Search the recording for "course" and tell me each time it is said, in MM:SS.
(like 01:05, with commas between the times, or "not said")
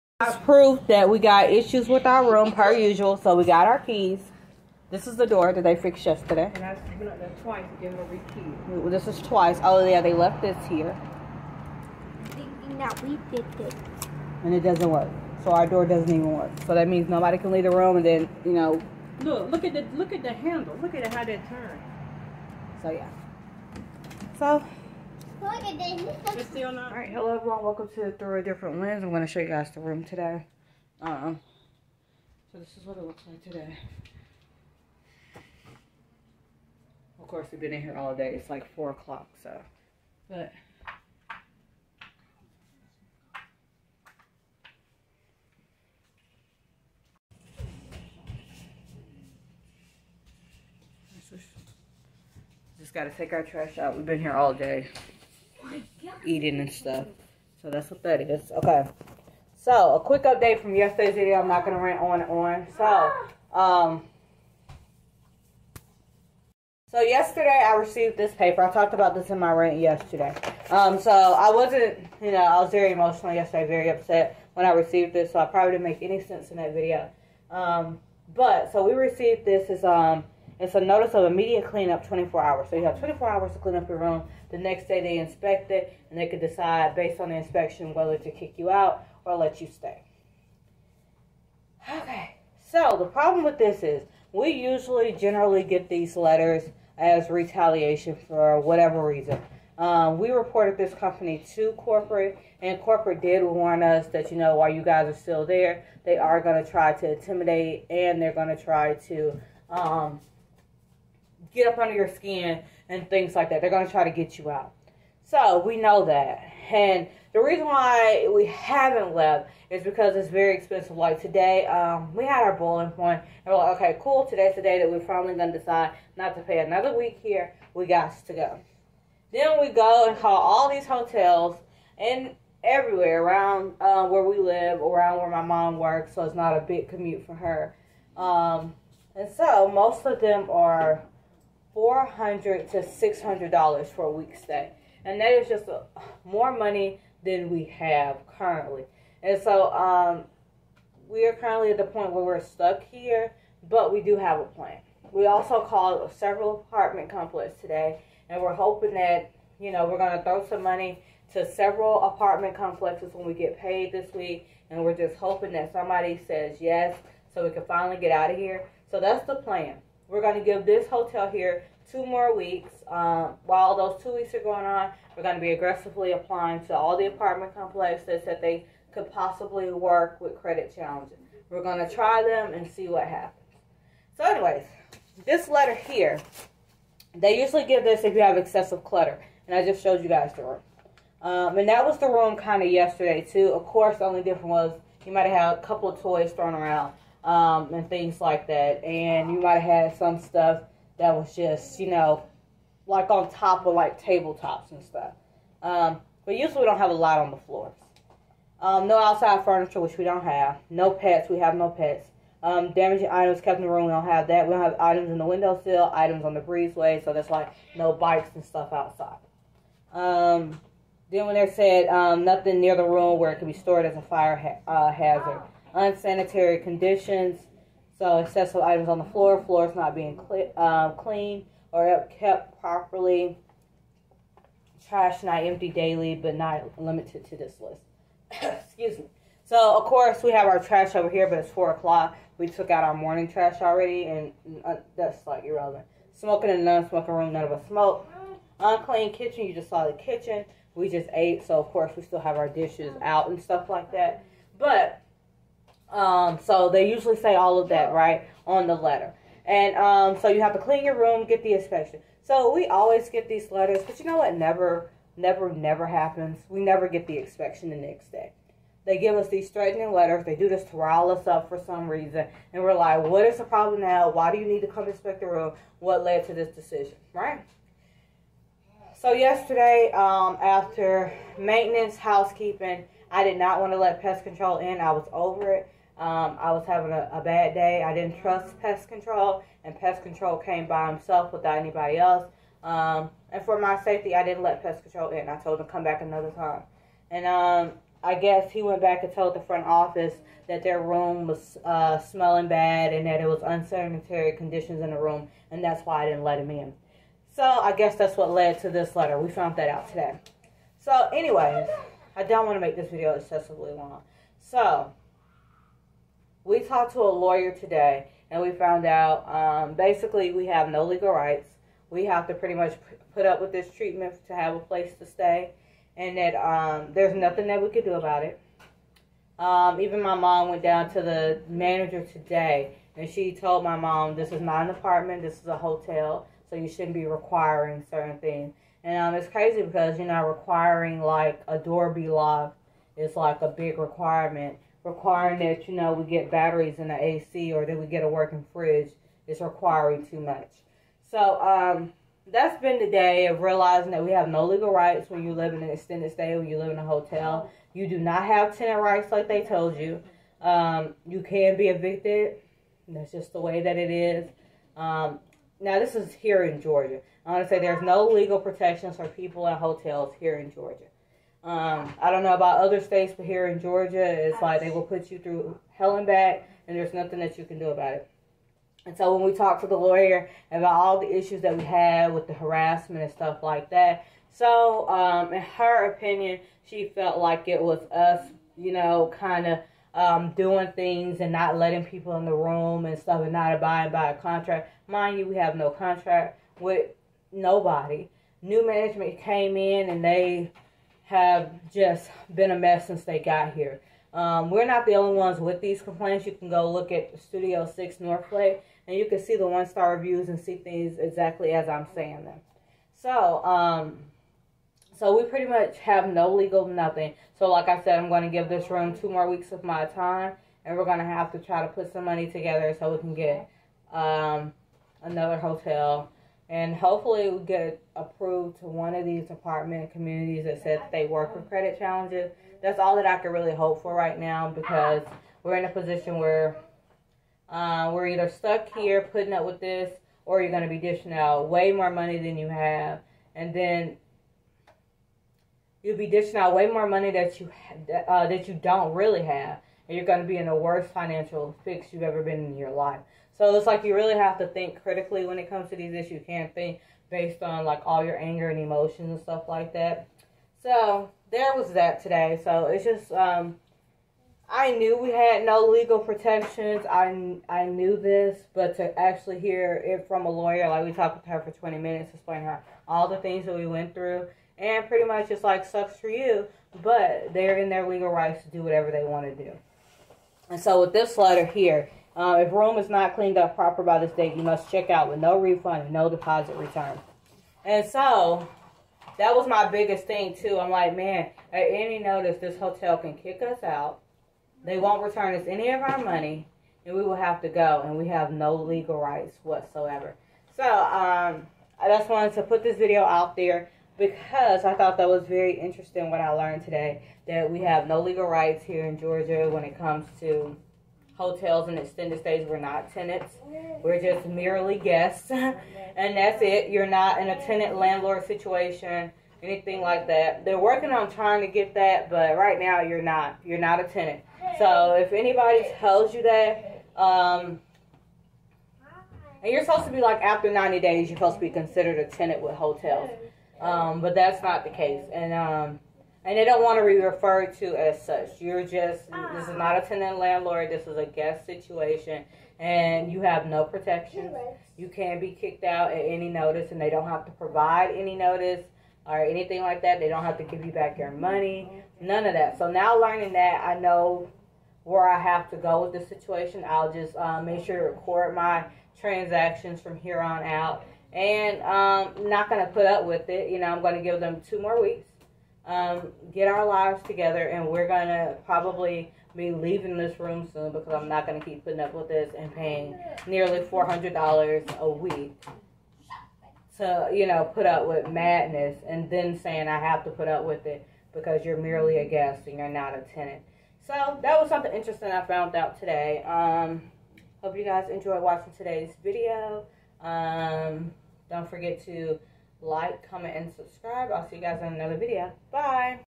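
00:37, 03:13, 03:59, 04:11.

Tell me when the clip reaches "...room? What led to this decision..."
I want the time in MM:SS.
04:35.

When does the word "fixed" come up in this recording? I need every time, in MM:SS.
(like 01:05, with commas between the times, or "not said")
00:05, 00:13.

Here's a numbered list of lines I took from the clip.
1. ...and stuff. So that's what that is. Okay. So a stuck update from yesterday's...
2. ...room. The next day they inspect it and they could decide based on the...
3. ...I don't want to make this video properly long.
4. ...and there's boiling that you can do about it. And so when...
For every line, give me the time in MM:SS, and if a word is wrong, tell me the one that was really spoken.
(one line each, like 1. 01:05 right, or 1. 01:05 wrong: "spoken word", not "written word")
1. 00:56 wrong: "quick", not "stuck"
2. 01:23 right
3. 05:12 wrong: "excessively", not "properly"
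4. 06:16 wrong: "nothing", not "boiling".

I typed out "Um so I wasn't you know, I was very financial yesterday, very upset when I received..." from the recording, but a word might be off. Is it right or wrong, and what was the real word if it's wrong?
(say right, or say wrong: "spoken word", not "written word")
wrong: "emotional", not "financial".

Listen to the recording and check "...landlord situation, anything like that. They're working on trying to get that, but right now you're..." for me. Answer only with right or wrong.
right.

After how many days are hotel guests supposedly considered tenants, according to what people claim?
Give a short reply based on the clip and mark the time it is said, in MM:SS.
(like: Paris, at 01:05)
90 days, at 08:50.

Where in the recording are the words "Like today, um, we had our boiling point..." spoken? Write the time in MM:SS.
02:00.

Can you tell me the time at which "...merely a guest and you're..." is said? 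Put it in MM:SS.
09:41.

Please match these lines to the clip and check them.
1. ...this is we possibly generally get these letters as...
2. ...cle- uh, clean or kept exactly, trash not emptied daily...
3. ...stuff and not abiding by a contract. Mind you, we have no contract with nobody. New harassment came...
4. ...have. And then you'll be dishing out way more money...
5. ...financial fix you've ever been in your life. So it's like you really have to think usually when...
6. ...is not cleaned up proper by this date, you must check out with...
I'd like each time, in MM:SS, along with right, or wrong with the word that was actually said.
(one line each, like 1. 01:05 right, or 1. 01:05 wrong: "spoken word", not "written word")
1. 01:33 wrong: "usually", not "possibly"
2. 03:50 wrong: "properly", not "exactly"
3. 06:32 wrong: "management", not "harassment"
4. 07:22 right
5. 07:30 wrong: "critically", not "usually"
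6. 08:02 right.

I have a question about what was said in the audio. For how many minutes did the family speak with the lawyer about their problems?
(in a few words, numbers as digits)
20 minutes.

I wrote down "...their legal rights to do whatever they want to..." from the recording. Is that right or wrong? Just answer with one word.
right.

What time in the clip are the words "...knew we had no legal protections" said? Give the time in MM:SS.
07:44.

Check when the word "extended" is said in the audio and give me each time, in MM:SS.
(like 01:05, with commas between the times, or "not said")
05:55, 08:31.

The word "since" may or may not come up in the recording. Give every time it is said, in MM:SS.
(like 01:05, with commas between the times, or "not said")
06:42.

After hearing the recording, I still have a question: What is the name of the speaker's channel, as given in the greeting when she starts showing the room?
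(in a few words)
Through a Different Lyns.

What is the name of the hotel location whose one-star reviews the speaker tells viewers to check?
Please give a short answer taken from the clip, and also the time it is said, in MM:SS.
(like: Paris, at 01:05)
Studio 6 Northway, at 06:47.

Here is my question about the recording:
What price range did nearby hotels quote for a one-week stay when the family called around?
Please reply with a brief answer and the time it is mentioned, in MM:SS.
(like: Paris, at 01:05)
$400 to $600, at 02:21.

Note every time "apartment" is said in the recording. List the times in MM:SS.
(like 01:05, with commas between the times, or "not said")
02:36, 02:42, 02:57, 05:34, 07:09.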